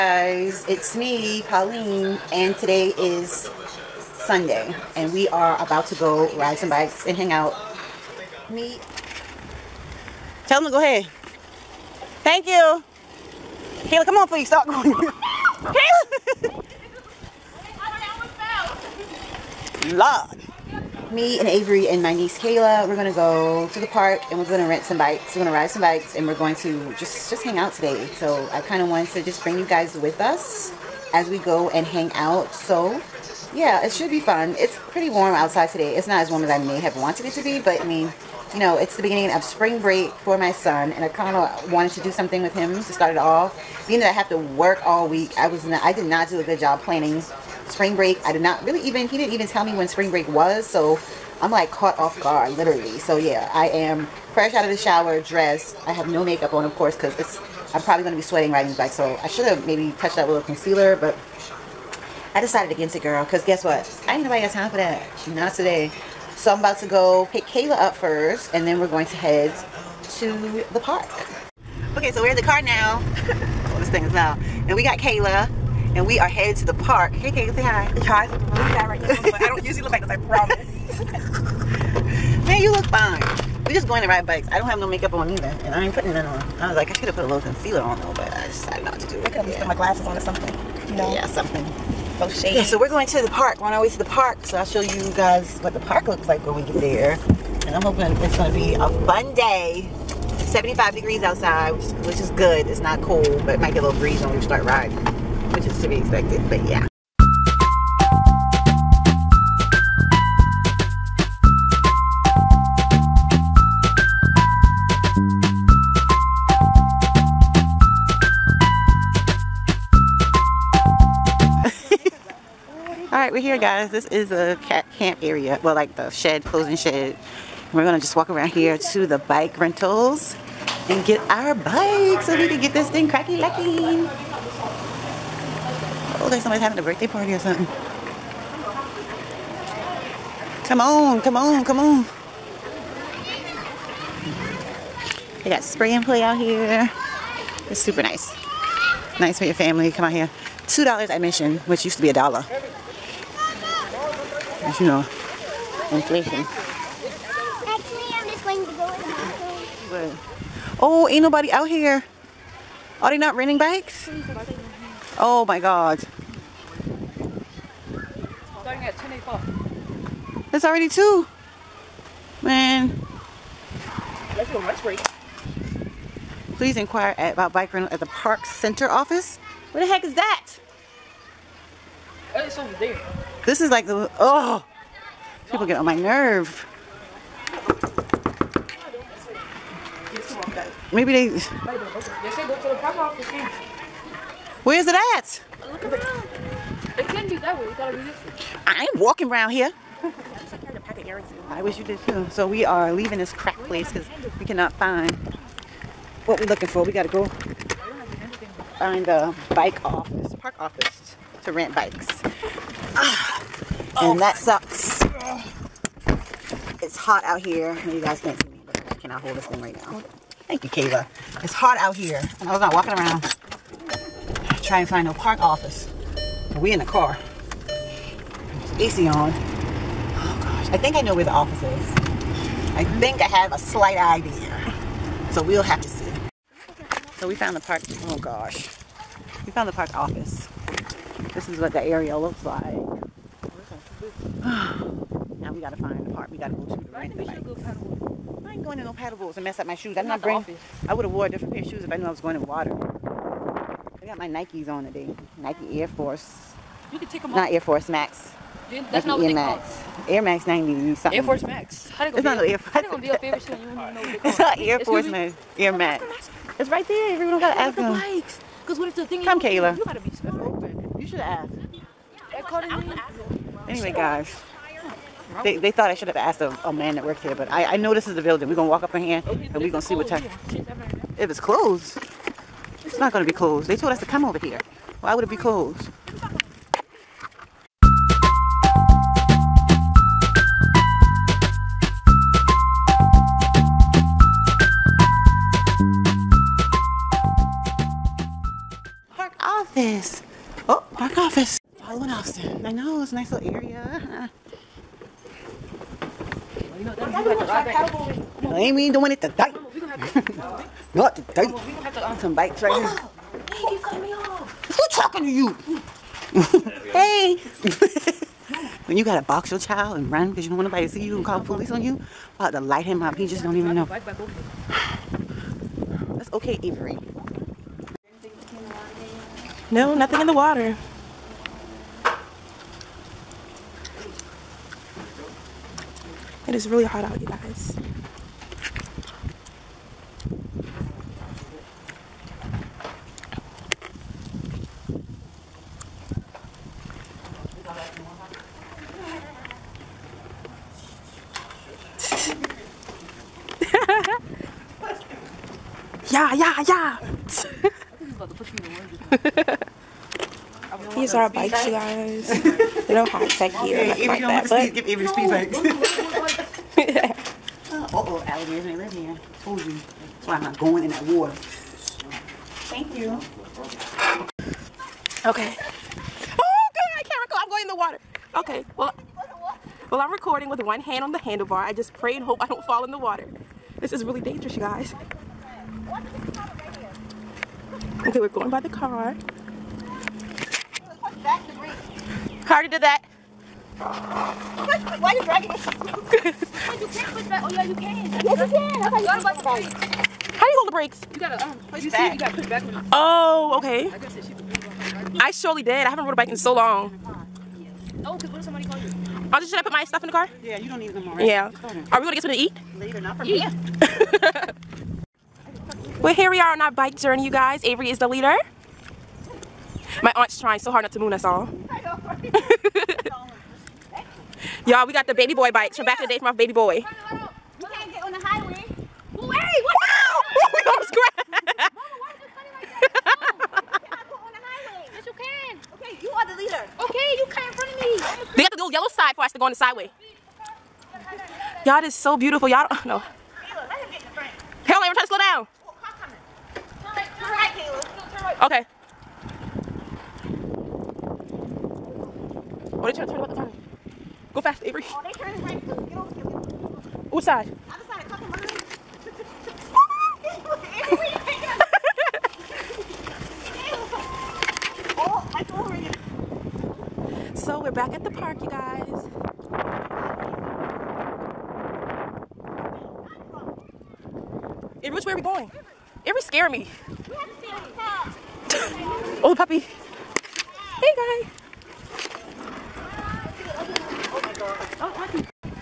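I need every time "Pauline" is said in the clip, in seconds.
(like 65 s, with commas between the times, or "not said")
1 s.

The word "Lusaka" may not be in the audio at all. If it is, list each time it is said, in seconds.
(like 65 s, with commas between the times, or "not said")
not said.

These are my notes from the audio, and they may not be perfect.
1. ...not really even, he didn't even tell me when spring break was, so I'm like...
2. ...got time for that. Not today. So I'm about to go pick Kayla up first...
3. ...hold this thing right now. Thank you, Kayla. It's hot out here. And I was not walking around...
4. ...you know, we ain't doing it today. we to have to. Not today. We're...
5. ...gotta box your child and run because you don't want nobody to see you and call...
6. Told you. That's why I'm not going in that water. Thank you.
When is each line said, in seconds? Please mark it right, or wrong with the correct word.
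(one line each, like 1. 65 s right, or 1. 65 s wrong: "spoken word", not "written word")
1. 48 s right
2. 64 s right
3. 219 s right
4. 306 s right
5. 319 s right
6. 369 s right.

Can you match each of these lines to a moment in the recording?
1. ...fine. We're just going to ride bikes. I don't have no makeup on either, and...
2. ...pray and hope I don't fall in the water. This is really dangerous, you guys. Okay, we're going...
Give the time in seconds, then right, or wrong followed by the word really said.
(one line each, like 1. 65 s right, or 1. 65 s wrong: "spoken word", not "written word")
1. 82 s right
2. 381 s right.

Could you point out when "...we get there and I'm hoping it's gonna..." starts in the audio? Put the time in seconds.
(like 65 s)
96 s.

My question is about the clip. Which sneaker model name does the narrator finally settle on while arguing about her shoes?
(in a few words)
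Air Max 90.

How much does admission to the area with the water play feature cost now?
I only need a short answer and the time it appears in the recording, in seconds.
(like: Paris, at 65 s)
$2, at 150 s.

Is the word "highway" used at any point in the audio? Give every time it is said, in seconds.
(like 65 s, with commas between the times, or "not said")
428 s, 434 s.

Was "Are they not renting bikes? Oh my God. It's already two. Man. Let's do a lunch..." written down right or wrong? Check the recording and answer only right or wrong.
right.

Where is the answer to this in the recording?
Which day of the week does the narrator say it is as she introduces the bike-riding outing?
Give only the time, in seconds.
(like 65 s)
4 s.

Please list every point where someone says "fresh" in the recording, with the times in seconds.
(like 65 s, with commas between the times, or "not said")
54 s.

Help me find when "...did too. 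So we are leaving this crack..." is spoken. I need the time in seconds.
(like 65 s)
201 s.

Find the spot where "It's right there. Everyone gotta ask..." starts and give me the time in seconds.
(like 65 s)
266 s.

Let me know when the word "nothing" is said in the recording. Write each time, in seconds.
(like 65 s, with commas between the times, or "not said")
329 s, 363 s.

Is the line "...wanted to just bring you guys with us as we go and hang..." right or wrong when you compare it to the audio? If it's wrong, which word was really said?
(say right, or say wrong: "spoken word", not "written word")
right.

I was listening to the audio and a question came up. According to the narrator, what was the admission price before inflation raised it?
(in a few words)
a dollar.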